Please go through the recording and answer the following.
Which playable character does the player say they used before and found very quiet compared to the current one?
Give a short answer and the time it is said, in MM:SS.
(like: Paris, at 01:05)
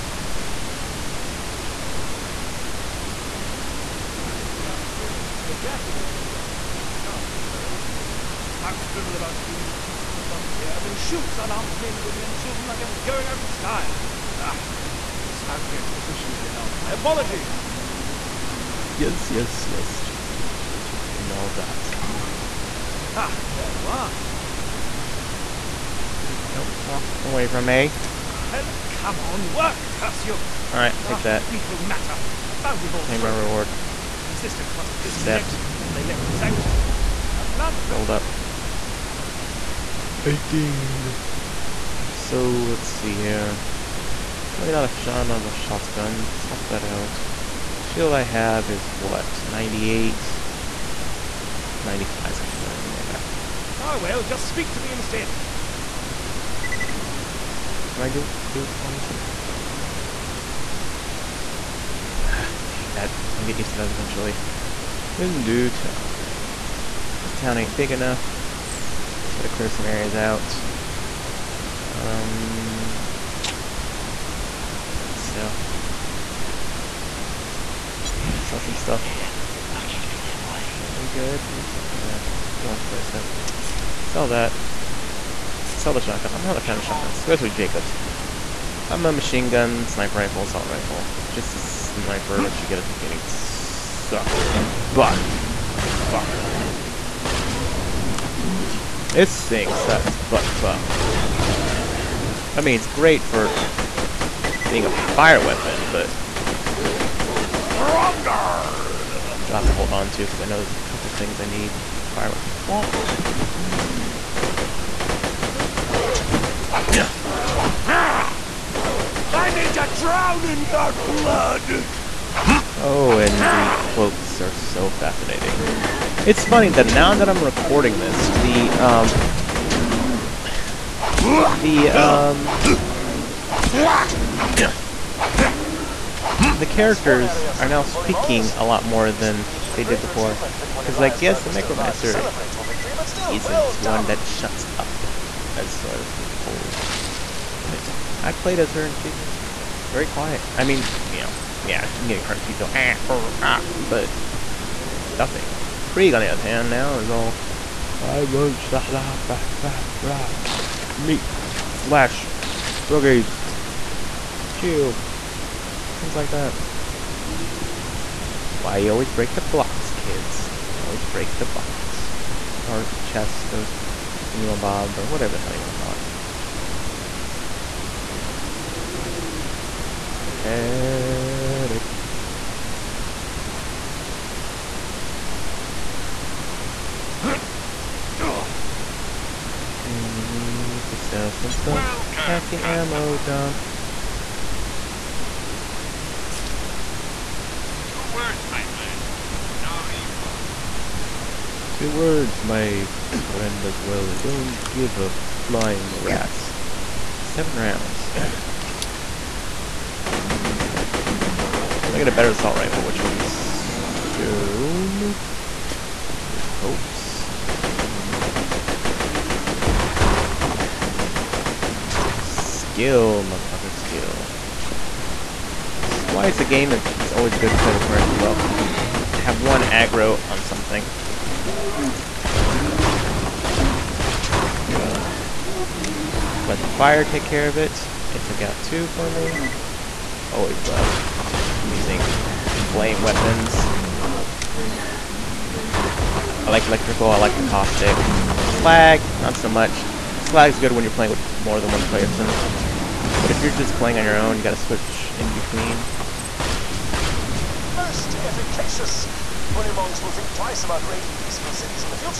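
Mechromancer, at 02:21.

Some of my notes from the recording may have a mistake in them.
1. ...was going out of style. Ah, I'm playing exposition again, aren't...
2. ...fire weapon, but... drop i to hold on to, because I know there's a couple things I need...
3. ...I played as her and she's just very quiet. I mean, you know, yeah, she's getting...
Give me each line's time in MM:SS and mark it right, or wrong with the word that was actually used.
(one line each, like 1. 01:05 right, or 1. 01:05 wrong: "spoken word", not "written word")
1. 00:12 wrong: "spouting", not "playing"
2. 01:44 right
3. 02:28 right.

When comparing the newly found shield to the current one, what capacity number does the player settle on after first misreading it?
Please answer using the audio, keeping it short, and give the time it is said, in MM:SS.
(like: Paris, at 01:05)
95, at 00:51.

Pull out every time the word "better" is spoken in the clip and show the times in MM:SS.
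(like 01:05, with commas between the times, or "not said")
00:52, 03:32.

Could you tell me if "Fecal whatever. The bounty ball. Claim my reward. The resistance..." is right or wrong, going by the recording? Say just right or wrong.
wrong.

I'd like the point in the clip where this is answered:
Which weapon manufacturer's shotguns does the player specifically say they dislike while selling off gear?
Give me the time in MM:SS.
01:27.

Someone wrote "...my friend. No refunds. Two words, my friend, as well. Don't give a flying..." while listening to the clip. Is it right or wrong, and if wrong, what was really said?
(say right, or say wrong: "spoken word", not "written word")
right.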